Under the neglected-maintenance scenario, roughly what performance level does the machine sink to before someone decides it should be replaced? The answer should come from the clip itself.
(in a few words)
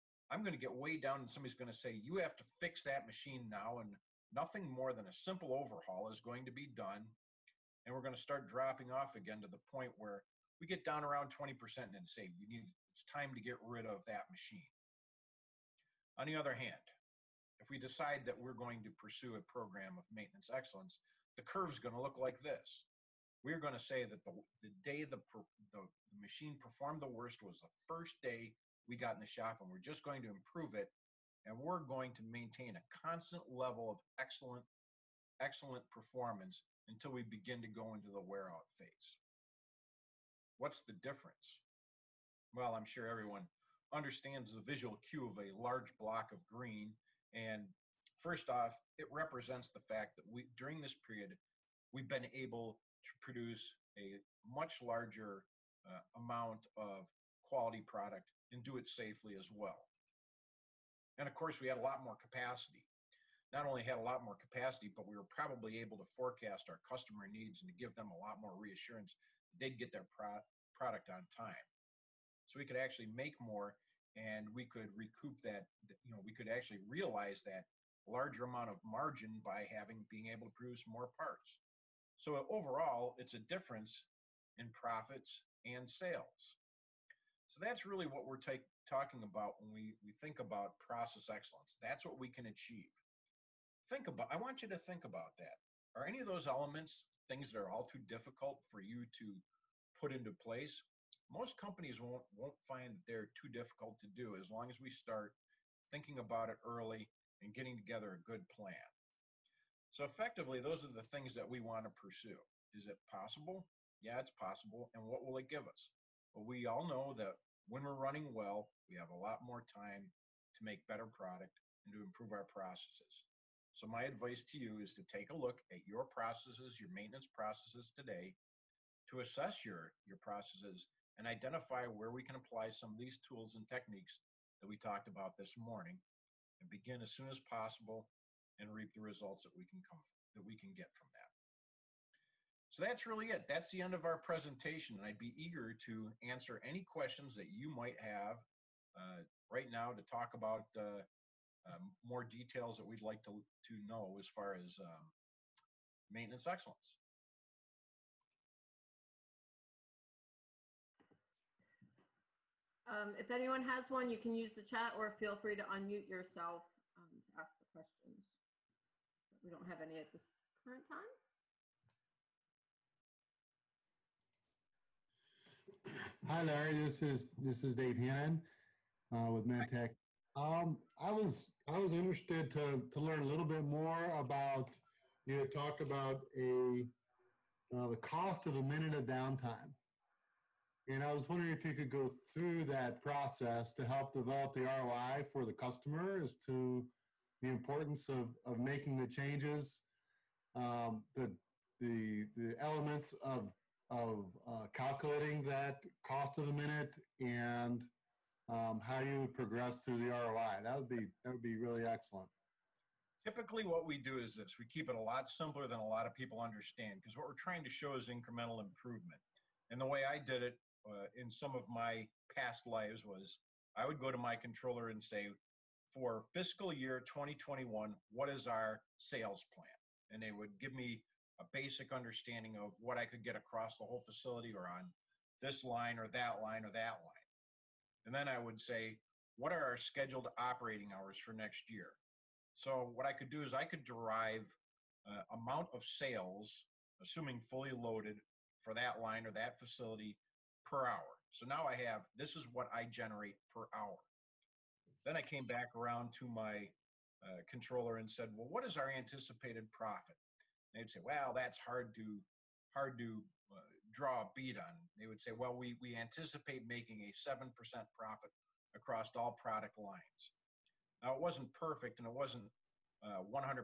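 20%.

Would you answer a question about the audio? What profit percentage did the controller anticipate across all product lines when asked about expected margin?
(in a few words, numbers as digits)
7%.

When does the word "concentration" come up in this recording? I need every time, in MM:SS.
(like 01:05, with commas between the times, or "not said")
not said.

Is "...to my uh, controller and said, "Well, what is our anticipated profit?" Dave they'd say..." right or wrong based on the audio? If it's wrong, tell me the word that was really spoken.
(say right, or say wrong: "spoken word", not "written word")
wrong: "And", not "Dave".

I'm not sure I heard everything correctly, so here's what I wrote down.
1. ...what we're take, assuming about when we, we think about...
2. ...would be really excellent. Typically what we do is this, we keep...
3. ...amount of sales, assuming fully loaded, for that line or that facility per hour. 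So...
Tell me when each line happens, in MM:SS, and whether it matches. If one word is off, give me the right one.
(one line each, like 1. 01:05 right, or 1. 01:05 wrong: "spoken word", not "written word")
1. 01:28 wrong: "talking", not "assuming"
2. 03:31 right
3. 04:05 right.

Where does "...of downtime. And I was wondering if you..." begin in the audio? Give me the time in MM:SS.
03:08.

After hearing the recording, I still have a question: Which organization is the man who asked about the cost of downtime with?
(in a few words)
Mantec.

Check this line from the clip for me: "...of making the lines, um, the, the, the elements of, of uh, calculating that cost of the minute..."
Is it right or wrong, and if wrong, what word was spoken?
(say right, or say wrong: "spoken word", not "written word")
wrong: "changes", not "lines".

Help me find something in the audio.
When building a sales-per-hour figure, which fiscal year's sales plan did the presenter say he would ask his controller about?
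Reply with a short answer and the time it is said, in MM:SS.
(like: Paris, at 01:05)
2021, at 03:47.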